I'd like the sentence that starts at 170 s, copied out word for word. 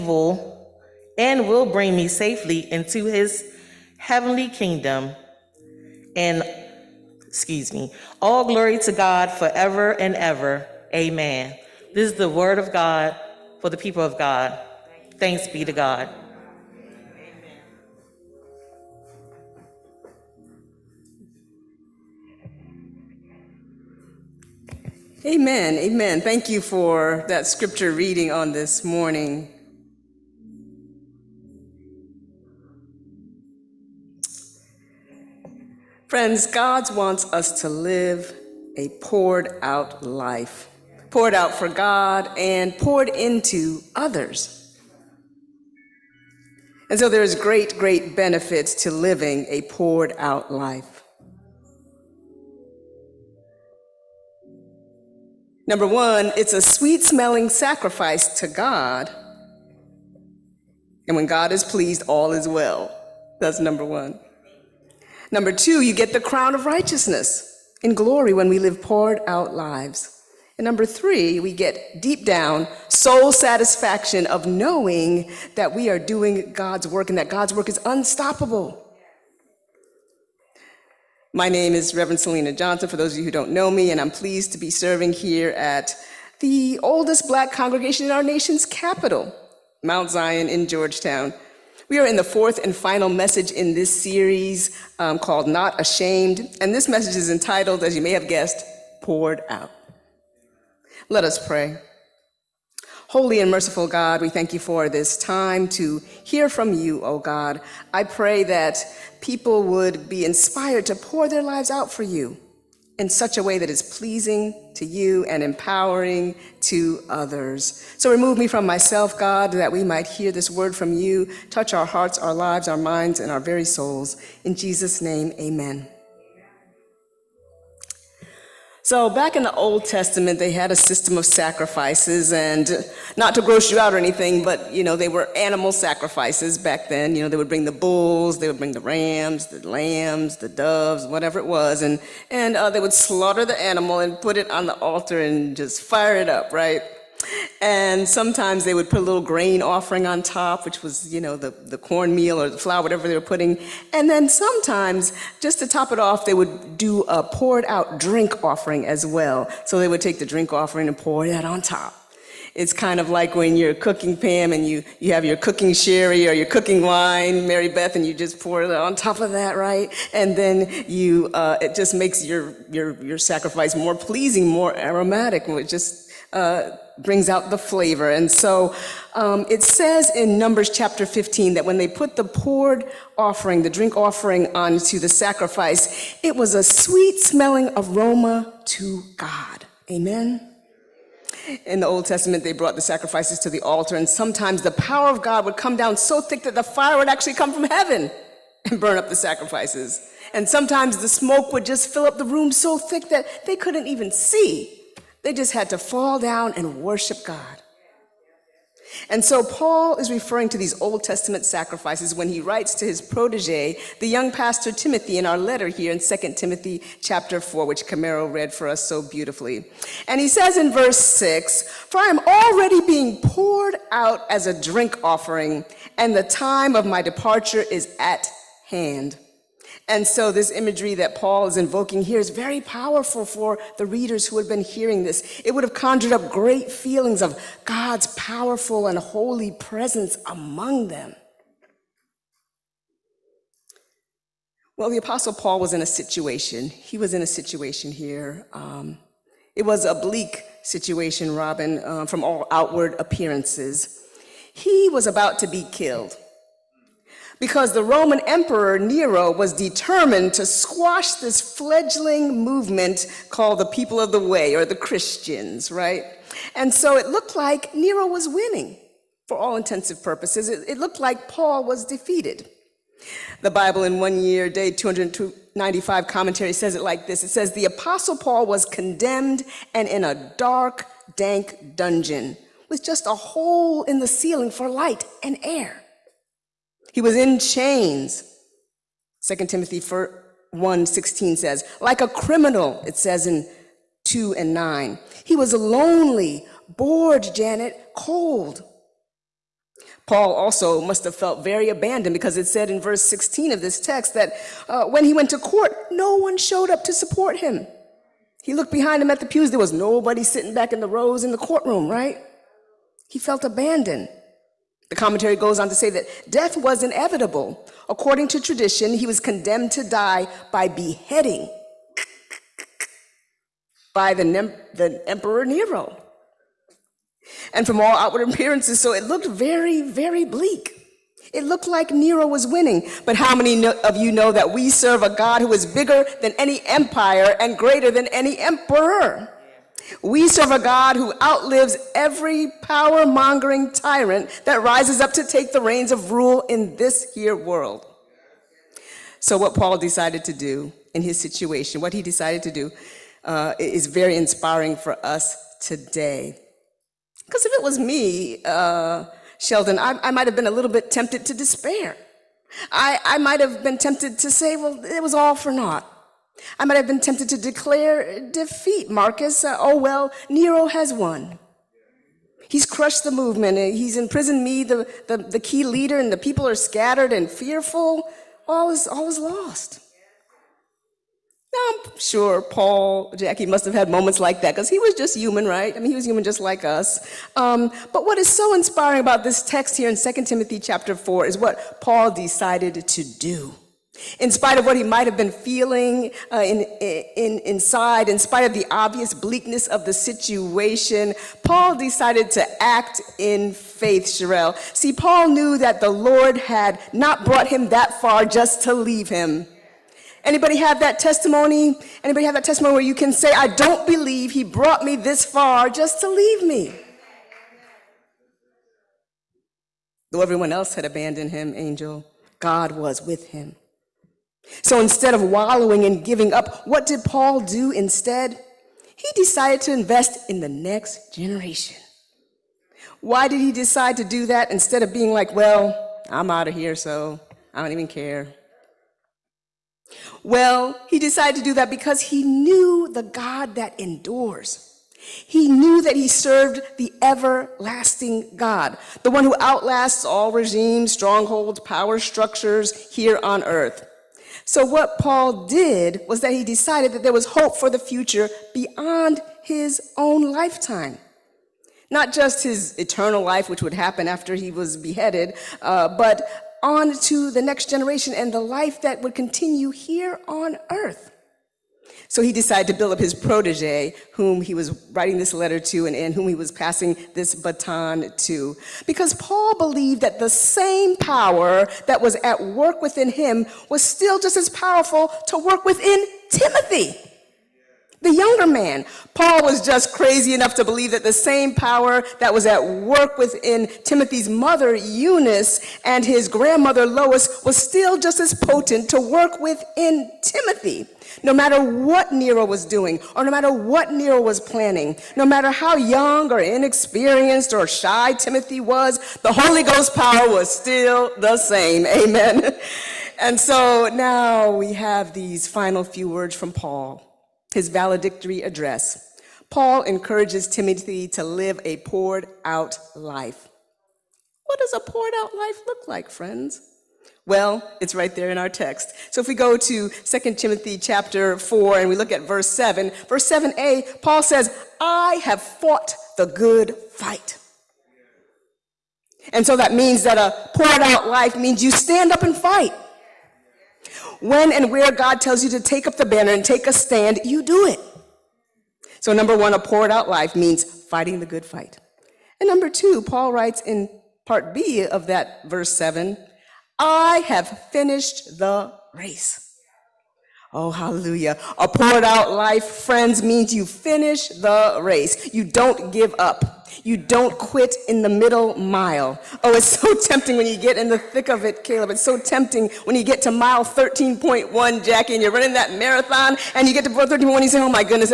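And then you, uh, it just makes your, your, your sacrifice more pleasing, more aromatic, just uh, brings out the flavor.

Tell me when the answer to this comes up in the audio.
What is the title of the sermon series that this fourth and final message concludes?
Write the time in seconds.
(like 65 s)
95 s.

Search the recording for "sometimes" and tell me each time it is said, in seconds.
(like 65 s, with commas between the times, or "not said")
148 s, 154 s, 194 s, 200 s.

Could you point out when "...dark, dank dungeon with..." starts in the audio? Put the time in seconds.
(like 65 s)
280 s.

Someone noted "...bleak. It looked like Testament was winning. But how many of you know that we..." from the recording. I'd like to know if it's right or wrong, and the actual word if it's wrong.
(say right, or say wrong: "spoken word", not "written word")
wrong: "Nero", not "Testament".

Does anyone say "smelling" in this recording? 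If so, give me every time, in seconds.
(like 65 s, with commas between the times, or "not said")
57 s, 187 s.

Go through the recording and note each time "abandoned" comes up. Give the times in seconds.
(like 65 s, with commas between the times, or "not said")
301 s, 313 s, 420 s.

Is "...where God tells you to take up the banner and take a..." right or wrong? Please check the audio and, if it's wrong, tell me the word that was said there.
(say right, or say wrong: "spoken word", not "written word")
right.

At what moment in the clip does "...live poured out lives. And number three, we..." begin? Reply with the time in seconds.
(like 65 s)
68 s.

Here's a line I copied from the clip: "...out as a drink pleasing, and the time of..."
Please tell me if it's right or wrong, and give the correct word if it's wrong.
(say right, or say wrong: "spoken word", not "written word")
wrong: "offering", not "pleasing".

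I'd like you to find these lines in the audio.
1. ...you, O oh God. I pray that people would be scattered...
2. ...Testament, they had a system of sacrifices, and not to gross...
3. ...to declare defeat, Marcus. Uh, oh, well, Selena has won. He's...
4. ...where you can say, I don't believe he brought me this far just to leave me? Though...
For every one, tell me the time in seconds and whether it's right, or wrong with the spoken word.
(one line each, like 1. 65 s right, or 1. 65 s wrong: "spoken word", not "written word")
1. 106 s wrong: "inspired", not "scattered"
2. 129 s right
3. 367 s wrong: "Nero", not "Selena"
4. 412 s right.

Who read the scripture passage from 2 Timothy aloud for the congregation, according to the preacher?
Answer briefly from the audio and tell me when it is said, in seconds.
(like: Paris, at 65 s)
Camaro, at 217 s.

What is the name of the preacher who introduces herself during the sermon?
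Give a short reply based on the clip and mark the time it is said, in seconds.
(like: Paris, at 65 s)
Reverend Selena Johnson, at 81 s.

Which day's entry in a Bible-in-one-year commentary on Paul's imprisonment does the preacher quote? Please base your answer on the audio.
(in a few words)
295.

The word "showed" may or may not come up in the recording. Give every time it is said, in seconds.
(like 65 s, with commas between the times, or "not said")
306 s.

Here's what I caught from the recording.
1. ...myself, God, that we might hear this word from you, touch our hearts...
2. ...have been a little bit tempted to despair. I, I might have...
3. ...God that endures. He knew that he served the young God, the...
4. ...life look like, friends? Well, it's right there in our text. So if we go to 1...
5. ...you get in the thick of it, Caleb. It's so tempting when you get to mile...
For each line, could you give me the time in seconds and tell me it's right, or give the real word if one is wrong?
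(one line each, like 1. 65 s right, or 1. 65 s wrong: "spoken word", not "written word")
1. 118 s right
2. 360 s right
3. 443 s wrong: "everlasting", not "young"
4. 525 s wrong: "2", not "1"
5. 570 s right.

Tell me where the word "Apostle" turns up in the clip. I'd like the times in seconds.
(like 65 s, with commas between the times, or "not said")
244 s, 277 s.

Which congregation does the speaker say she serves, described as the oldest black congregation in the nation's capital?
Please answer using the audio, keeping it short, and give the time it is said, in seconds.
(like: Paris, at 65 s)
Mount Zion, at 89 s.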